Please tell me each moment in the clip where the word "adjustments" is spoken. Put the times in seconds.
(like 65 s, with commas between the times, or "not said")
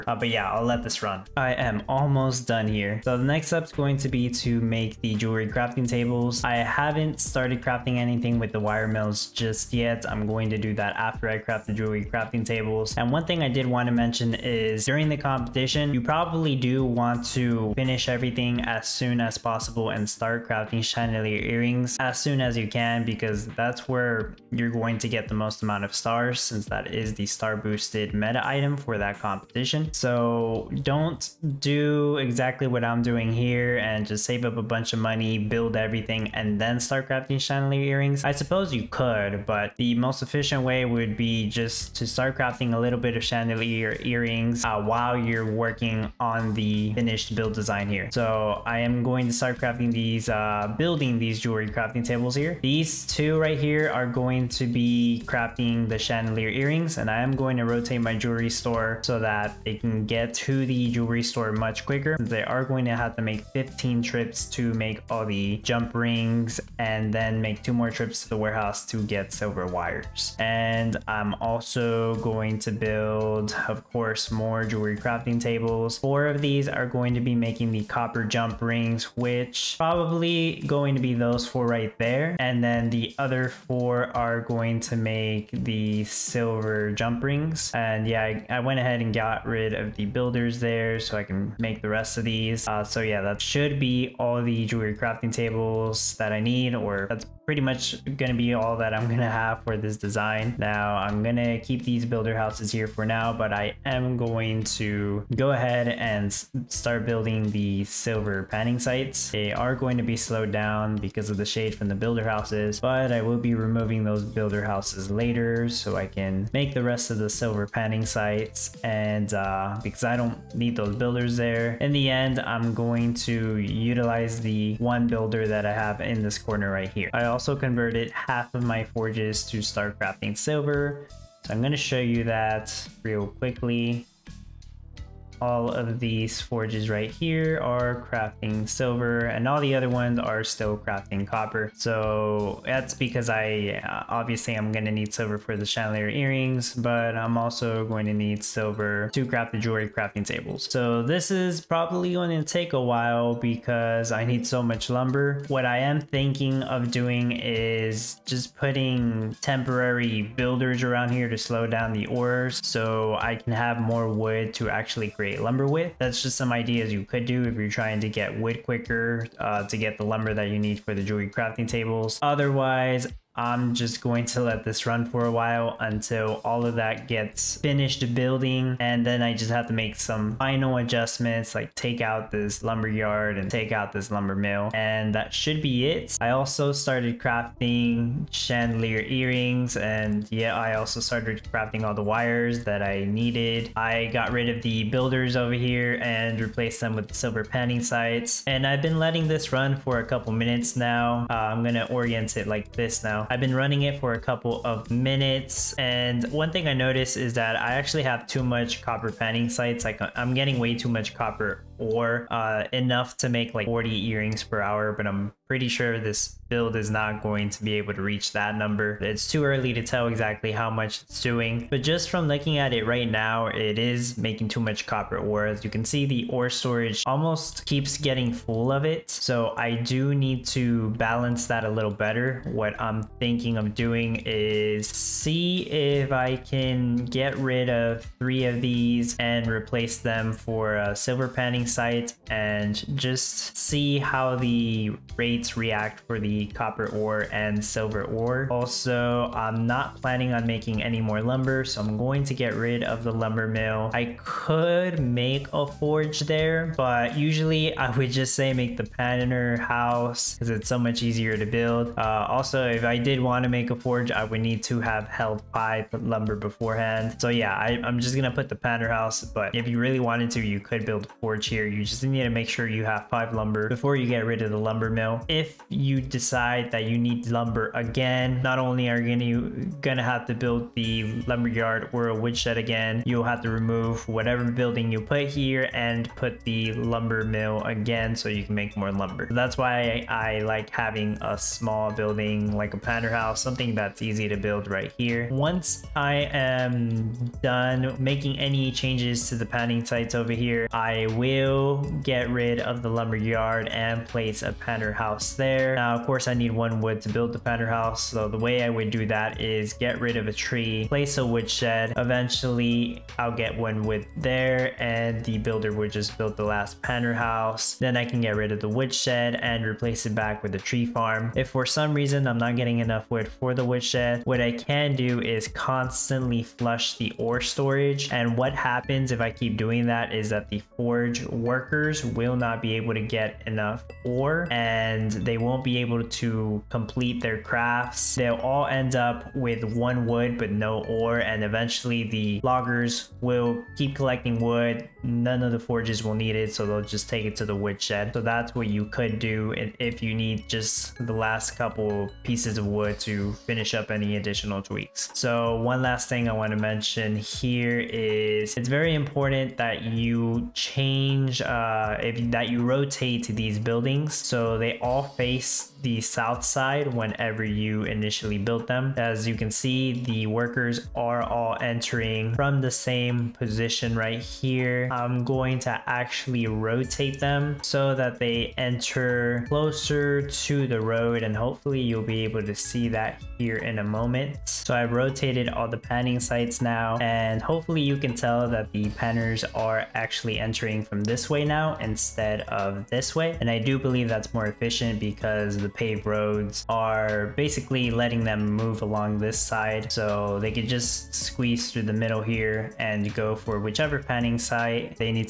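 180 s.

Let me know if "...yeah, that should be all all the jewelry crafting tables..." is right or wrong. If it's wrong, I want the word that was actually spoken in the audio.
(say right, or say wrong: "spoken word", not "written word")
right.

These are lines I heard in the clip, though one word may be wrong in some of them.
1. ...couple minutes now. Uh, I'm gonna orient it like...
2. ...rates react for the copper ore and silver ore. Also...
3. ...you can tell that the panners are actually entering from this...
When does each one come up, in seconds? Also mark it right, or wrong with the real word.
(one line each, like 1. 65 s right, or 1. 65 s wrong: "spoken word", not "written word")
1. 200 s right
2. 245 s right
3. 387 s right.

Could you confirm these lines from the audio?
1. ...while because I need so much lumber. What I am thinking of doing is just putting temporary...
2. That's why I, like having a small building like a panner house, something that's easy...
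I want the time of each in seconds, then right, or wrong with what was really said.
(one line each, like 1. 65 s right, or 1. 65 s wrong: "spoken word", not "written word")
1. 152 s right
2. 289 s right.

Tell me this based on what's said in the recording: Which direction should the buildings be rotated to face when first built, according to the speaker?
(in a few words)
south.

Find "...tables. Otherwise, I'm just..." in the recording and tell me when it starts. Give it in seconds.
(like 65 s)
171 s.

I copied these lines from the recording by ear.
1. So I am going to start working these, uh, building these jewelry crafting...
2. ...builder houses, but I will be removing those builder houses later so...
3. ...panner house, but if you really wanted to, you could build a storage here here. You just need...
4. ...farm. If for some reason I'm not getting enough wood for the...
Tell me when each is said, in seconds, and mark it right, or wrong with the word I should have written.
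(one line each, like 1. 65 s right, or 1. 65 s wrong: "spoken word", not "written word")
1. 48 s wrong: "crafting", not "working"
2. 111 s right
3. 268 s wrong: "forge", not "storage"
4. 320 s right.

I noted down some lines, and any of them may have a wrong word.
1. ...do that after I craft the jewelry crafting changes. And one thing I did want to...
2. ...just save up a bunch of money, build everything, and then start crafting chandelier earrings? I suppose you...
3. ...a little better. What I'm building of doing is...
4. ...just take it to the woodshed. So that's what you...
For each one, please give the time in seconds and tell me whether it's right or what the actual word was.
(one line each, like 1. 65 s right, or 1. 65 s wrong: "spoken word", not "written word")
1. 10 s wrong: "tables", not "changes"
2. 34 s right
3. 231 s wrong: "thinking", not "building"
4. 346 s right.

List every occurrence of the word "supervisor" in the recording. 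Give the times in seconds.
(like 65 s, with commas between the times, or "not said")
not said.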